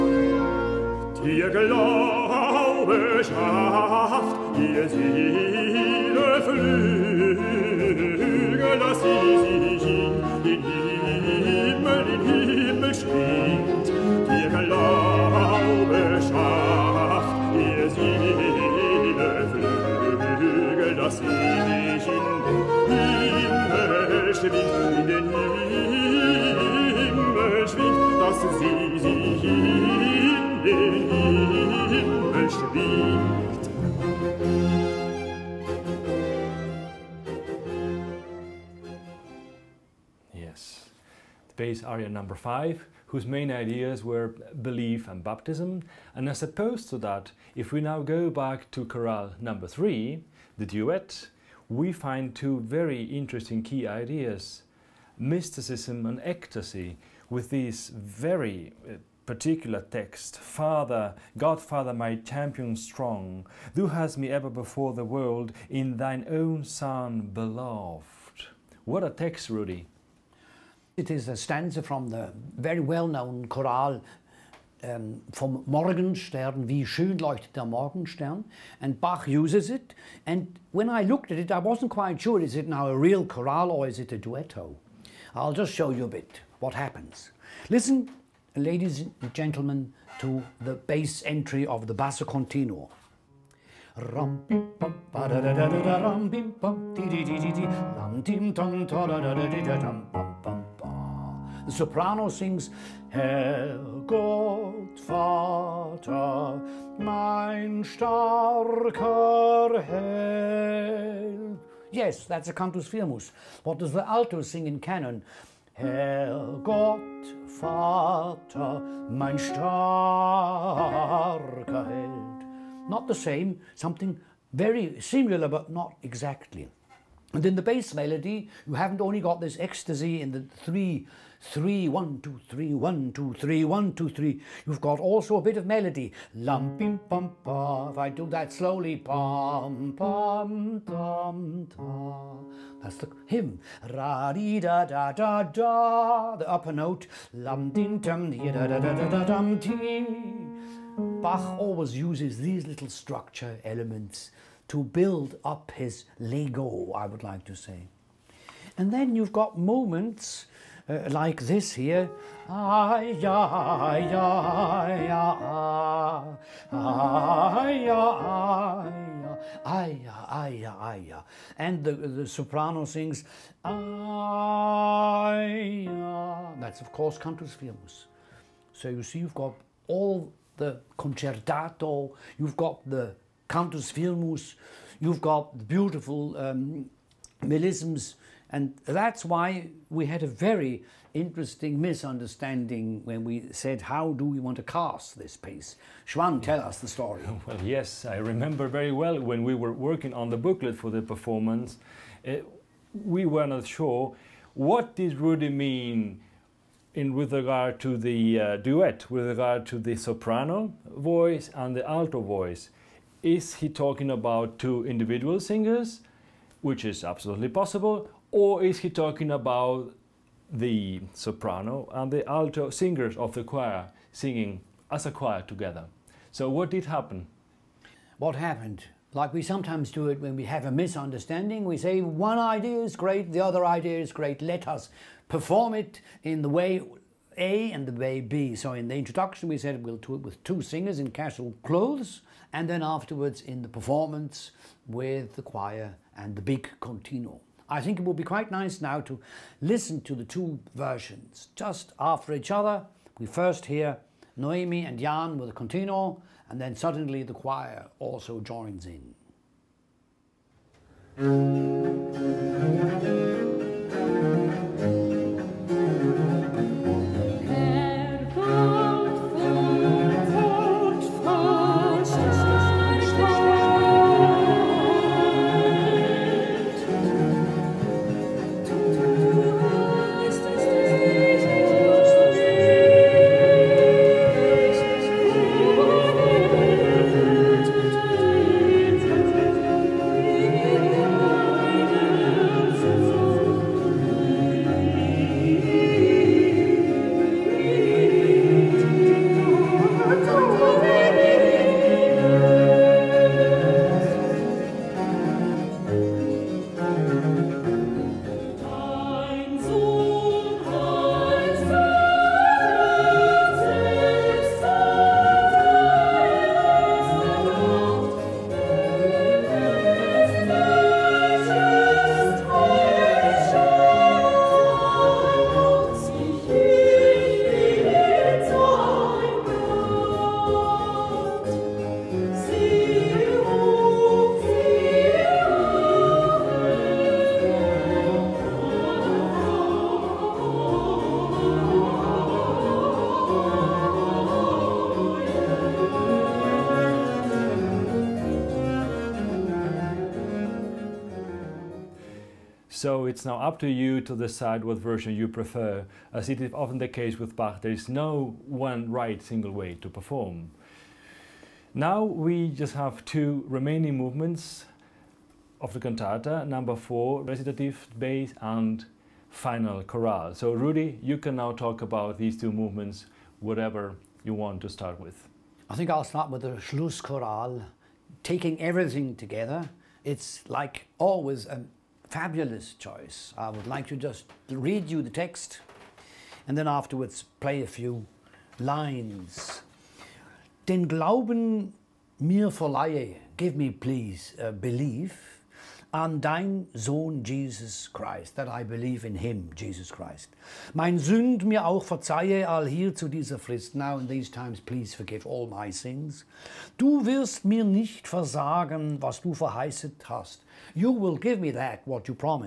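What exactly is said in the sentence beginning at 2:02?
Not the same, something very similar but not exactly.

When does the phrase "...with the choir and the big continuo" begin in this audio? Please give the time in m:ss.
4:04.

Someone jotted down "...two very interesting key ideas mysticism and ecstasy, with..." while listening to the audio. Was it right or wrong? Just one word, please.
right.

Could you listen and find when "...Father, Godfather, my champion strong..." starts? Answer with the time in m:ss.
1:00.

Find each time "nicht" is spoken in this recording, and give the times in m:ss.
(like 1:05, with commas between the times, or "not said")
6:47.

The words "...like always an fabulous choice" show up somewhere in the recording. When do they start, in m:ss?
6:20.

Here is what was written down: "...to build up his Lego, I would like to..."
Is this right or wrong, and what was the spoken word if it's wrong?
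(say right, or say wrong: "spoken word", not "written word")
right.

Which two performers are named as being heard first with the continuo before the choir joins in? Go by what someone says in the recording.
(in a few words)
Noemi and Jan.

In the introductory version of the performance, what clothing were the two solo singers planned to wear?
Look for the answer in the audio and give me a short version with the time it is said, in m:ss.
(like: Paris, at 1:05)
casual clothes, at 4:01.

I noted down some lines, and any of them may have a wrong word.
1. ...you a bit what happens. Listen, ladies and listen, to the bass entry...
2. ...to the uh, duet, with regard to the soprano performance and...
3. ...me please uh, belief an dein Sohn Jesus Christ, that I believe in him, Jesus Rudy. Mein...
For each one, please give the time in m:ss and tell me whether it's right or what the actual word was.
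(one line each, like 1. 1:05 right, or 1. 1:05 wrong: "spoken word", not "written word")
1. 1:25 wrong: "gentlemen", not "listen"
2. 3:27 wrong: "voice", not "performance"
3. 6:33 wrong: "Christ", not "Rudy".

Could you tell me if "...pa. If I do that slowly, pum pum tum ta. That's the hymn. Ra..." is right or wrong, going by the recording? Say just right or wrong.
right.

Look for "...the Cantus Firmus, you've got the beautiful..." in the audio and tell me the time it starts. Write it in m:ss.
3:02.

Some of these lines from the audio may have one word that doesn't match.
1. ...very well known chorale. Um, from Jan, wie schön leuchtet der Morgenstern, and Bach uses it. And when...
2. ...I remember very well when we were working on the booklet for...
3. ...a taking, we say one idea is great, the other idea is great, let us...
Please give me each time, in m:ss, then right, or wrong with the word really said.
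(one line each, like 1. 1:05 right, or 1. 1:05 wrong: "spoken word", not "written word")
1. 1:12 wrong: "Morgenstern", not "Jan"
2. 3:18 right
3. 3:50 wrong: "misunderstanding", not "taking".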